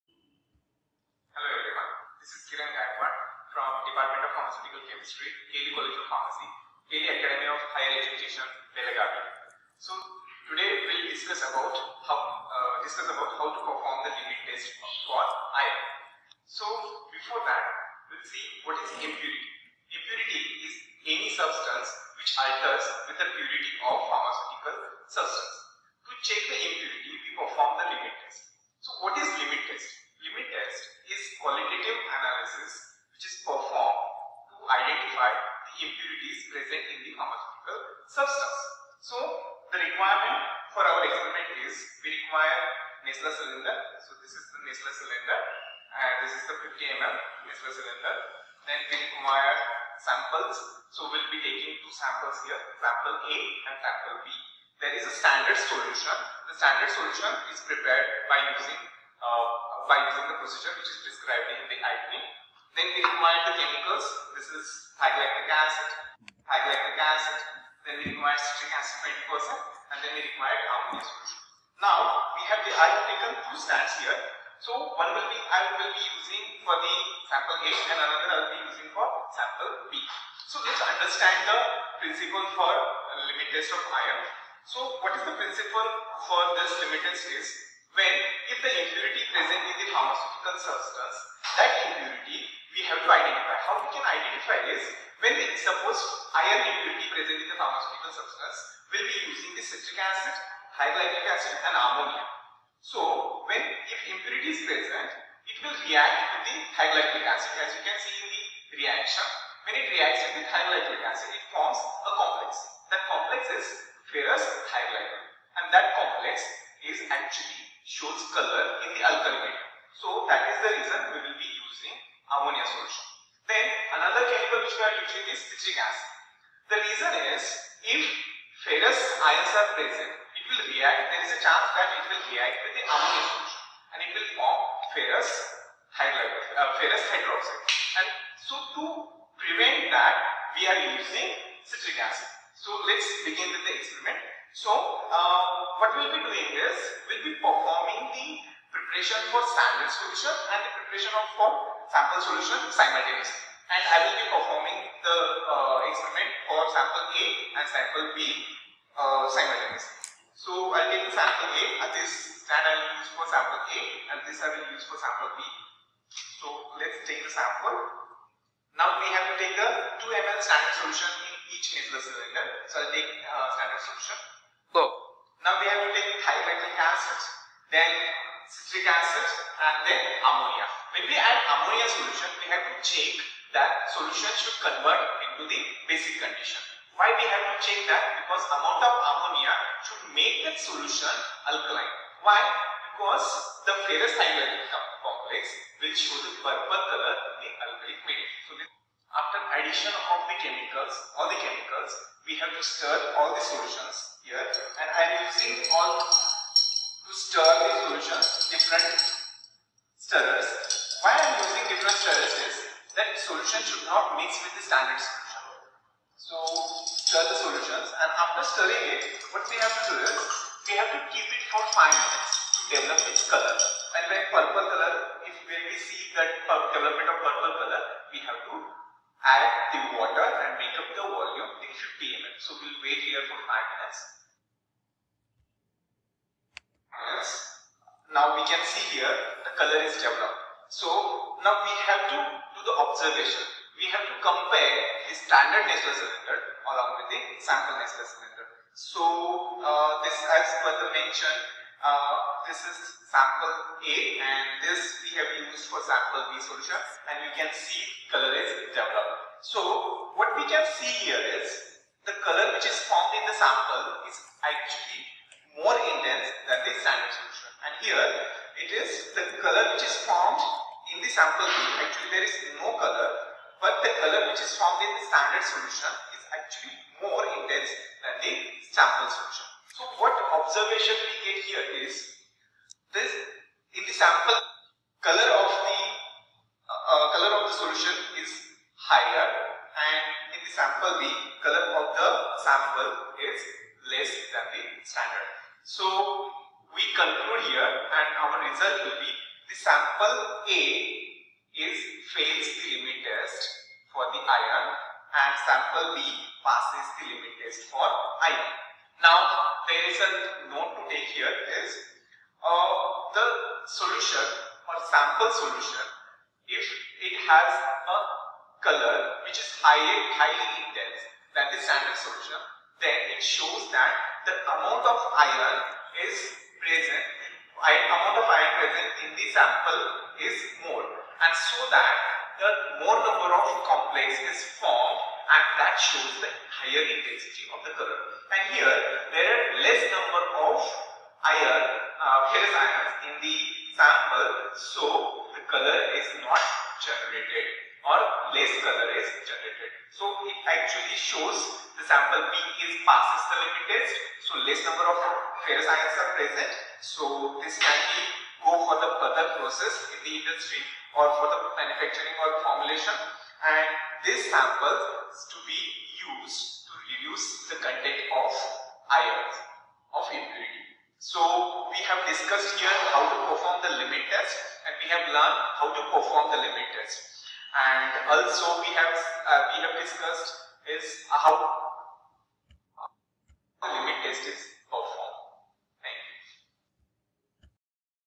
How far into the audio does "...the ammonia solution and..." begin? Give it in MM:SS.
02:12.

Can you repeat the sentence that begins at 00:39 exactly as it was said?
So, the requirement for our experiment is we require Nessler cylinder.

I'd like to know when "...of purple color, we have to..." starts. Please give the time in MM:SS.
03:47.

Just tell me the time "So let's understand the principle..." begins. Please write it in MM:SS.
01:20.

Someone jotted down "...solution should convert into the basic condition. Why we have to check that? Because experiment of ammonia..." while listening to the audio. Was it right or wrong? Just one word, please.
wrong.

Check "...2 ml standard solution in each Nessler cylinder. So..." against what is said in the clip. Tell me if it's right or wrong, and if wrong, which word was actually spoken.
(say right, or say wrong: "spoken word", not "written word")
right.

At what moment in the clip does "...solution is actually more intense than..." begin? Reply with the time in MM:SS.
04:35.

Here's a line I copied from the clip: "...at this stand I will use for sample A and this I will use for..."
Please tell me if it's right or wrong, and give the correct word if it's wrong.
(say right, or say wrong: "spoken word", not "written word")
right.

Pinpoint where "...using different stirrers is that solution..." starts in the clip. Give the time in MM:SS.
03:31.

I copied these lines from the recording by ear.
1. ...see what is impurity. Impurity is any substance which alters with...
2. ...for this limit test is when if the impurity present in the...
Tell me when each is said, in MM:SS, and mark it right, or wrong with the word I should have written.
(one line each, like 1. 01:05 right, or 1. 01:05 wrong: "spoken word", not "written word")
1. 00:18 right
2. 01:26 right.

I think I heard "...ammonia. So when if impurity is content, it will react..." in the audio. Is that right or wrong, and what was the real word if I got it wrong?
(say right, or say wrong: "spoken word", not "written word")
wrong: "present", not "content".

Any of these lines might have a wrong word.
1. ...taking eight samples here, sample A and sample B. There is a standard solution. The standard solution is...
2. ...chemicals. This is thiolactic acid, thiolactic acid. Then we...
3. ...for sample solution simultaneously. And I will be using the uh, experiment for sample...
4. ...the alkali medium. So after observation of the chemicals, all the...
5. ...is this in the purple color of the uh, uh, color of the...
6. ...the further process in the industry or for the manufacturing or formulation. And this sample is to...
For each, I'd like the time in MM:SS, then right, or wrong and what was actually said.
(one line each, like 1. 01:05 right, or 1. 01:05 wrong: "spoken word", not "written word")
1. 00:51 wrong: "two", not "eight"
2. 01:03 right
3. 02:31 wrong: "performing", not "using"
4. 03:17 wrong: "addition", not "observation"
5. 04:41 wrong: "sample", not "purple"
6. 05:58 right.